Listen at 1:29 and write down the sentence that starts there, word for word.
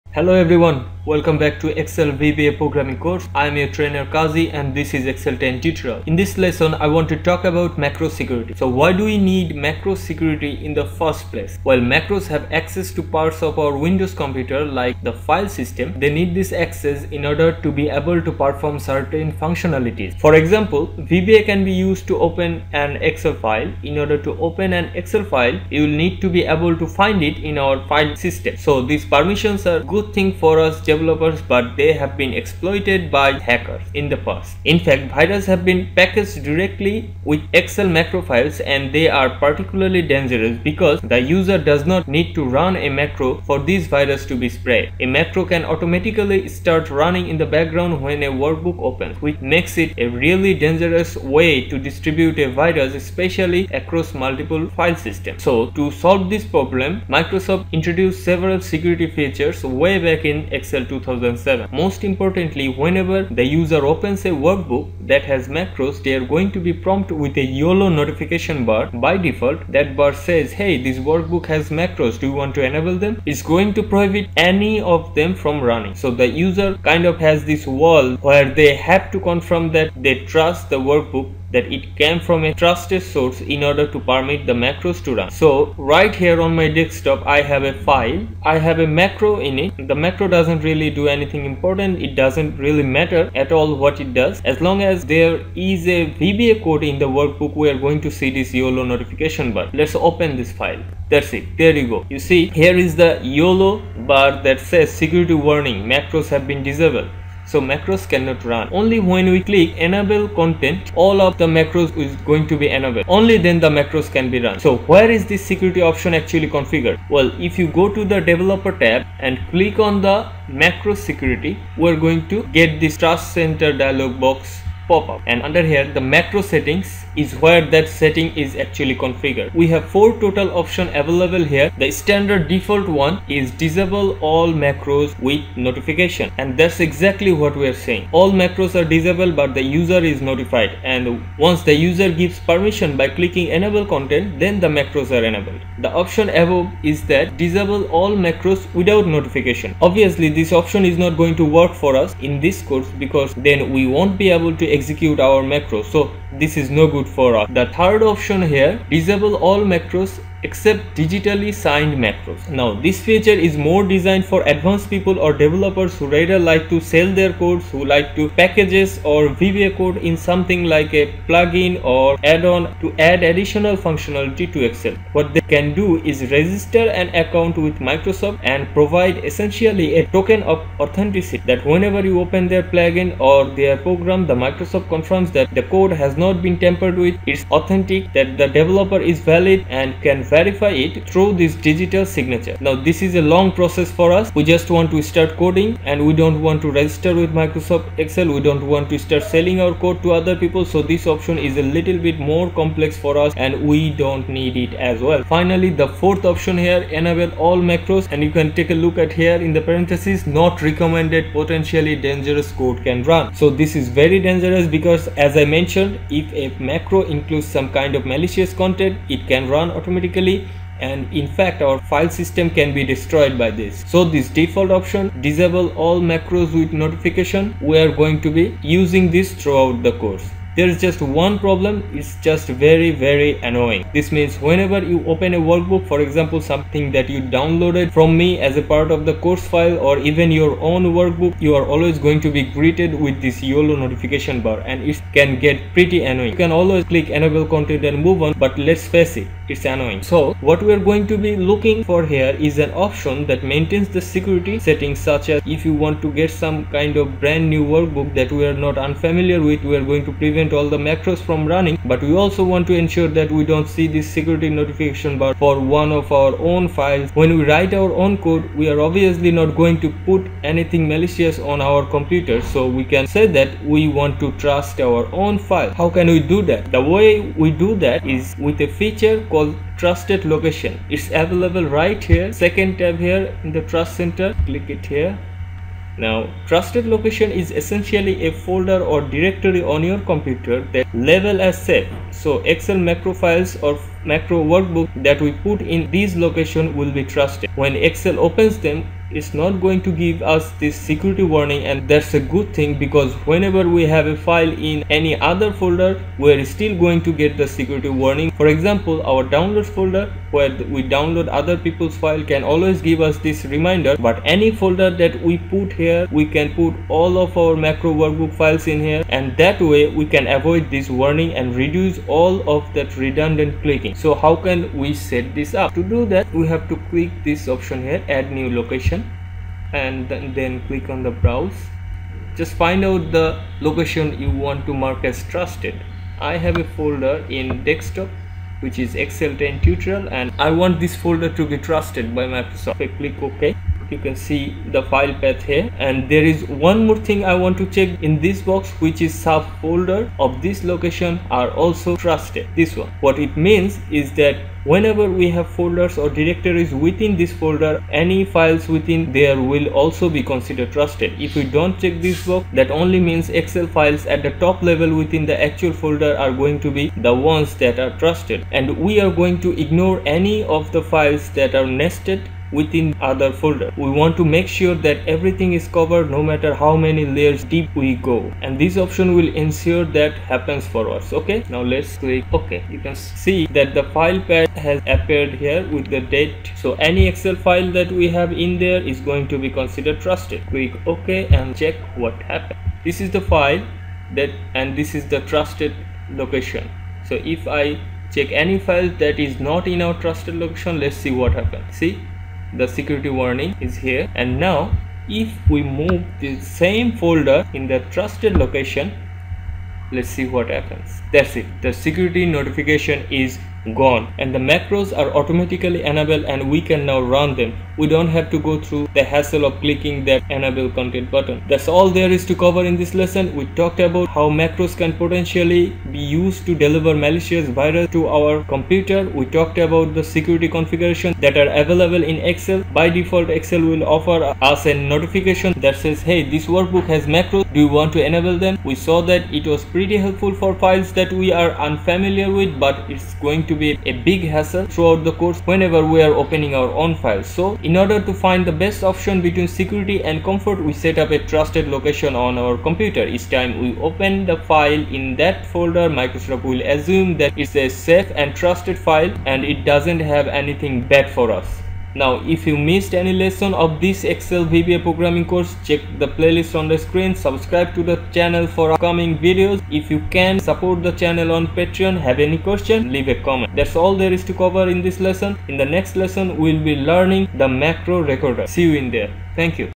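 The macro doesn't really do anything important, it doesn't really matter at all what it does.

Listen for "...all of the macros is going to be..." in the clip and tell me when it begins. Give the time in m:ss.
1:51.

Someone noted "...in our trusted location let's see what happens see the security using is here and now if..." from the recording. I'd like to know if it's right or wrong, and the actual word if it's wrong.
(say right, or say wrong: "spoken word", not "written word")
wrong: "warning", not "using".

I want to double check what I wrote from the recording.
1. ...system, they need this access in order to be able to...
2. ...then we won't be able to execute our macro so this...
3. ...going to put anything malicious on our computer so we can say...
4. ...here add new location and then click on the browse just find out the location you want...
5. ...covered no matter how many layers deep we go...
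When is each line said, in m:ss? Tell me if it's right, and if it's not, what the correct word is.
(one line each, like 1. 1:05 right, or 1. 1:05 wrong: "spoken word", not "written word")
1. 0:15 right
2. 2:33 right
3. 4:29 right
4. 5:27 right
5. 6:15 right.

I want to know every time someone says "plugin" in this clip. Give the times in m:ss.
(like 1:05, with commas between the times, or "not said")
2:51, 3:02.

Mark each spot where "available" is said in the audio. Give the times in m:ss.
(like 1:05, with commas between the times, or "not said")
2:11, 4:41, 7:11.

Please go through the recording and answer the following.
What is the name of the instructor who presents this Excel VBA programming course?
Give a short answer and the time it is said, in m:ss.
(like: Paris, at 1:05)
Kazi, at 0:04.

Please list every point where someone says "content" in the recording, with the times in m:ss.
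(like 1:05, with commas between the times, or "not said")
1:50, 2:23, 3:38, 4:07, 7:00.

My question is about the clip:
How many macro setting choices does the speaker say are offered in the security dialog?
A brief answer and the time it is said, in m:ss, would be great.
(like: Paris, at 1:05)
4, at 2:09.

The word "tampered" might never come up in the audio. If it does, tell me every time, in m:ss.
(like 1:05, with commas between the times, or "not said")
3:06.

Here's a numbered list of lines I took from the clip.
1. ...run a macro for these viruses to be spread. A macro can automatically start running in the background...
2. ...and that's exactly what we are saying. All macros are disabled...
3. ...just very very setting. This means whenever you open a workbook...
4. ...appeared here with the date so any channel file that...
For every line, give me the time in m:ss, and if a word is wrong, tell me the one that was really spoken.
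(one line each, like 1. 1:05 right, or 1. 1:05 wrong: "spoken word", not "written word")
1. 0:42 right
2. 2:16 right
3. 3:52 wrong: "annoying", not "setting"
4. 6:24 wrong: "excel", not "channel".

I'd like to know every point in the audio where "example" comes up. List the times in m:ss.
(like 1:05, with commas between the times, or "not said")
0:20, 3:56, 5:08.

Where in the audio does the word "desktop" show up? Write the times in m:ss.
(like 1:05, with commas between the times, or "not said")
1:26, 5:37.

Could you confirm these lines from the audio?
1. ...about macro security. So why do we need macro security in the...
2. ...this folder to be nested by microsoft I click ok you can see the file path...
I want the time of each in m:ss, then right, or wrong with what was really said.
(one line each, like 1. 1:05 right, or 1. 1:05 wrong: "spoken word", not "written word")
1. 0:07 right
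2. 5:40 wrong: "trusted", not "nested".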